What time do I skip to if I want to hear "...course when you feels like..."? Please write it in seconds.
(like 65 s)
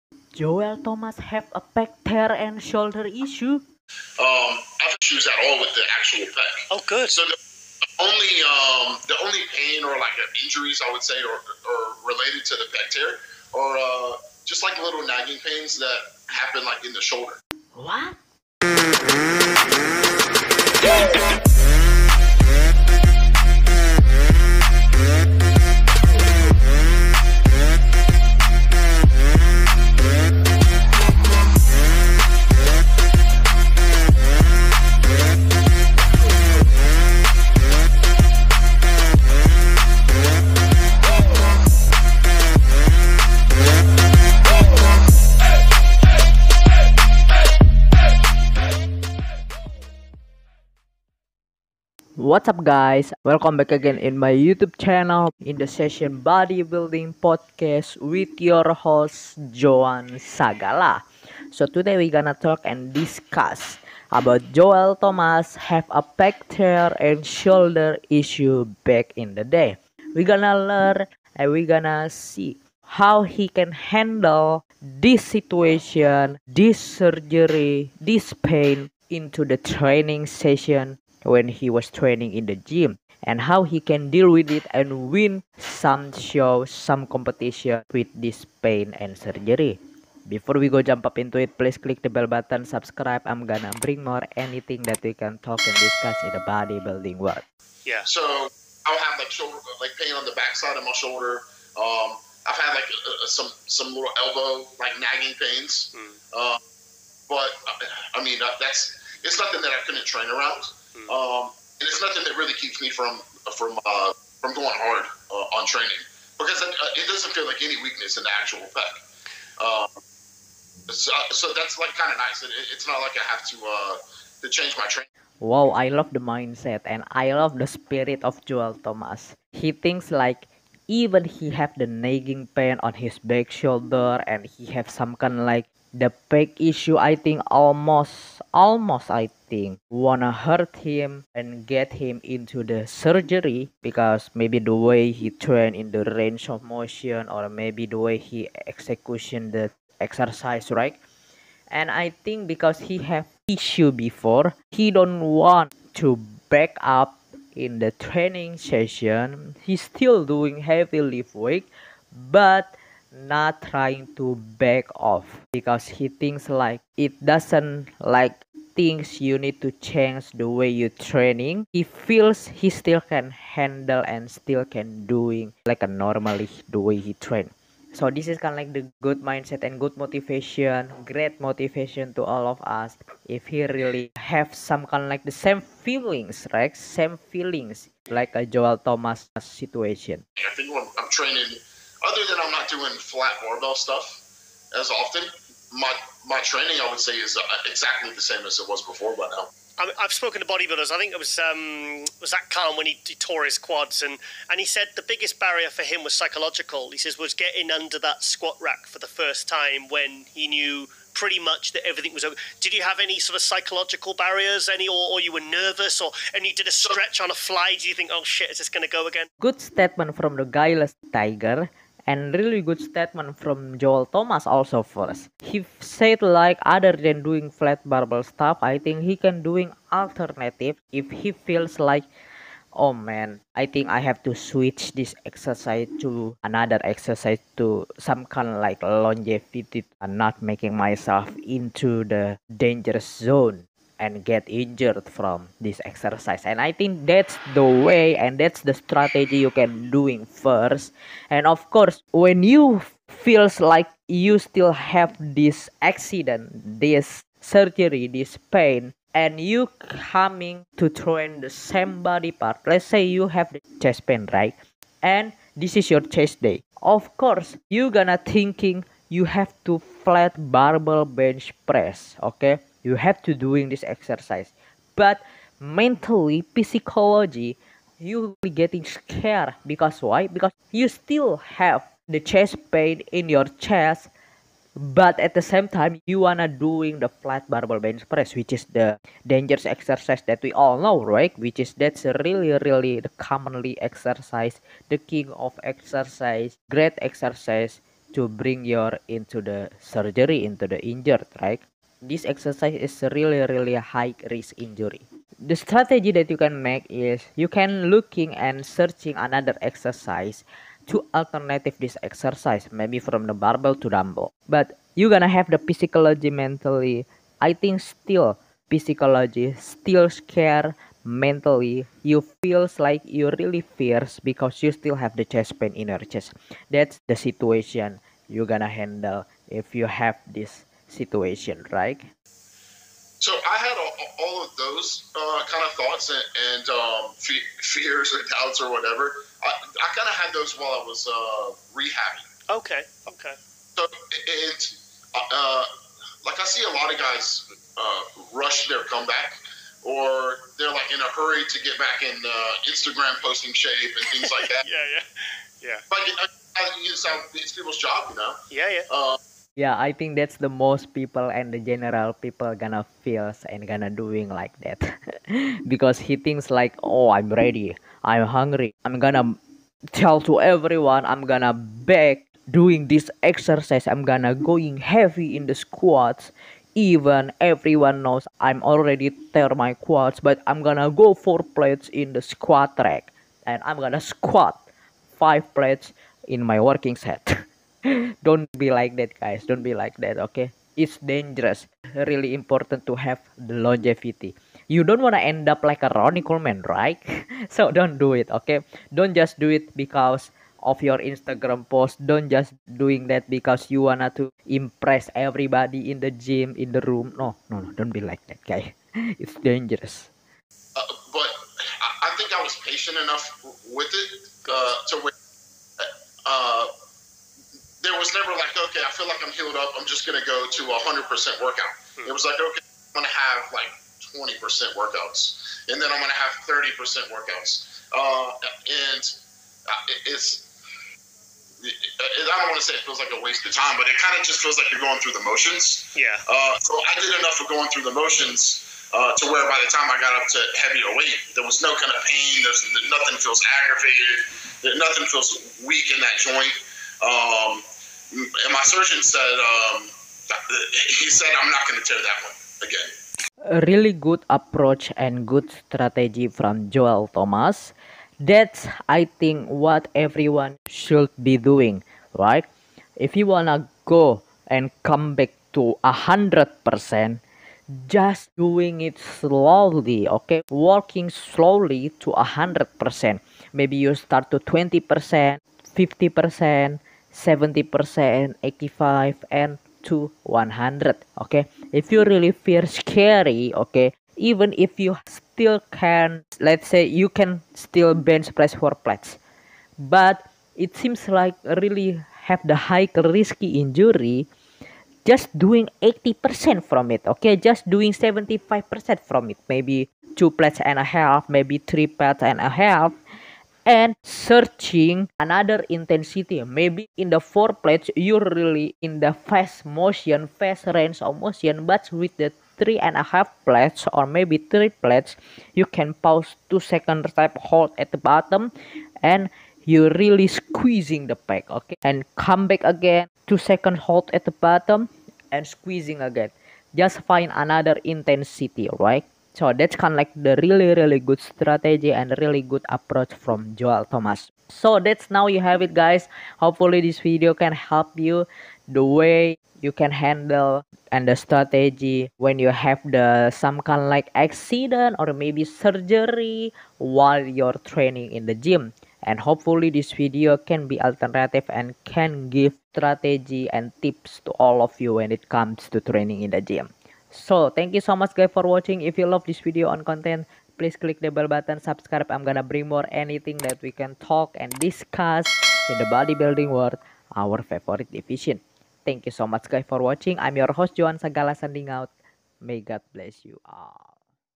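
251 s.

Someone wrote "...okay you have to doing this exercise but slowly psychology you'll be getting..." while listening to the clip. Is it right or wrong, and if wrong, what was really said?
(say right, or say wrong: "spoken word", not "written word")
wrong: "mentally", not "slowly".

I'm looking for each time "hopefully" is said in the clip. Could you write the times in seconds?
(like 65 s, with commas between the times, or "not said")
536 s, 549 s.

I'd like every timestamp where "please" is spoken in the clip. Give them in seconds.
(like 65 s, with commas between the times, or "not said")
91 s, 560 s.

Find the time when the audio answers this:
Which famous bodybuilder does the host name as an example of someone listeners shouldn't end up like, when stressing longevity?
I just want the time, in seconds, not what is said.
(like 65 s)
395 s.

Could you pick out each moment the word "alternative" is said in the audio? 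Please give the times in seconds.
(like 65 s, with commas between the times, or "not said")
229 s, 311 s, 550 s.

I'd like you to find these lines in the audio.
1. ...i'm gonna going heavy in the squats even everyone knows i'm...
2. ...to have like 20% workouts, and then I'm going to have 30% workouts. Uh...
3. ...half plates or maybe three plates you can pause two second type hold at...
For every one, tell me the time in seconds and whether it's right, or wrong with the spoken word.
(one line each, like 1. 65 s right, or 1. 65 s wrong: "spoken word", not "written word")
1. 373 s right
2. 423 s right
3. 513 s right.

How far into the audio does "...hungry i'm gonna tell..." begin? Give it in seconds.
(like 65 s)
368 s.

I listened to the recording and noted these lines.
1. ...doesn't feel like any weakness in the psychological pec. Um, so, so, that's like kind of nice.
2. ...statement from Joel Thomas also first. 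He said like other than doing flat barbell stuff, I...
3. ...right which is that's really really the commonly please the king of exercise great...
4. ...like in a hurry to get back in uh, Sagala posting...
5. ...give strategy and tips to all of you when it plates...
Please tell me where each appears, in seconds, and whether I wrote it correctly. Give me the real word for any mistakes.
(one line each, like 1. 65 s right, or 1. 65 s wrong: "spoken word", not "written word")
1. 117 s wrong: "actual", not "psychological"
2. 222 s right
3. 291 s wrong: "exercise", not "please"
4. 350 s wrong: "Instagram", not "Sagala"
5. 552 s wrong: "comes", not "plates".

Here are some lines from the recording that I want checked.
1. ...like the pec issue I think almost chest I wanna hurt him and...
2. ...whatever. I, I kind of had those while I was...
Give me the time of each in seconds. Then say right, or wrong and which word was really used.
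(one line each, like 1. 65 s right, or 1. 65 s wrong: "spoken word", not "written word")
1. 135 s wrong: "almost", not "chest"
2. 338 s right.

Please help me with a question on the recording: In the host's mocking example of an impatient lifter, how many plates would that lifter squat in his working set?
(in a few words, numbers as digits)
5 plates.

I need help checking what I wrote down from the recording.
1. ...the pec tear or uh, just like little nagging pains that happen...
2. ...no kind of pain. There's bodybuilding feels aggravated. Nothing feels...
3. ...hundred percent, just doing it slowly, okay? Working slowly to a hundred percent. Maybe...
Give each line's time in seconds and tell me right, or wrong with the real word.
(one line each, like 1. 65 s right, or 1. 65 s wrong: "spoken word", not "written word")
1. 12 s right
2. 441 s wrong: "nothing", not "bodybuilding"
3. 465 s right.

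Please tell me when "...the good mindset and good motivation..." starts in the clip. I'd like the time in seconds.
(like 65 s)
178 s.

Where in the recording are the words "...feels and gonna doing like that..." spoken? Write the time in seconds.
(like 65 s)
363 s.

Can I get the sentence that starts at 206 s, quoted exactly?
He says was getting under that squat rack for the first time when he knew pretty much that everything was over.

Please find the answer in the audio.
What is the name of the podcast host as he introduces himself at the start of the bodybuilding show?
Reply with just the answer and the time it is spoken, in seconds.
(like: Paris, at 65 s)
Joan Sagala, at 59 s.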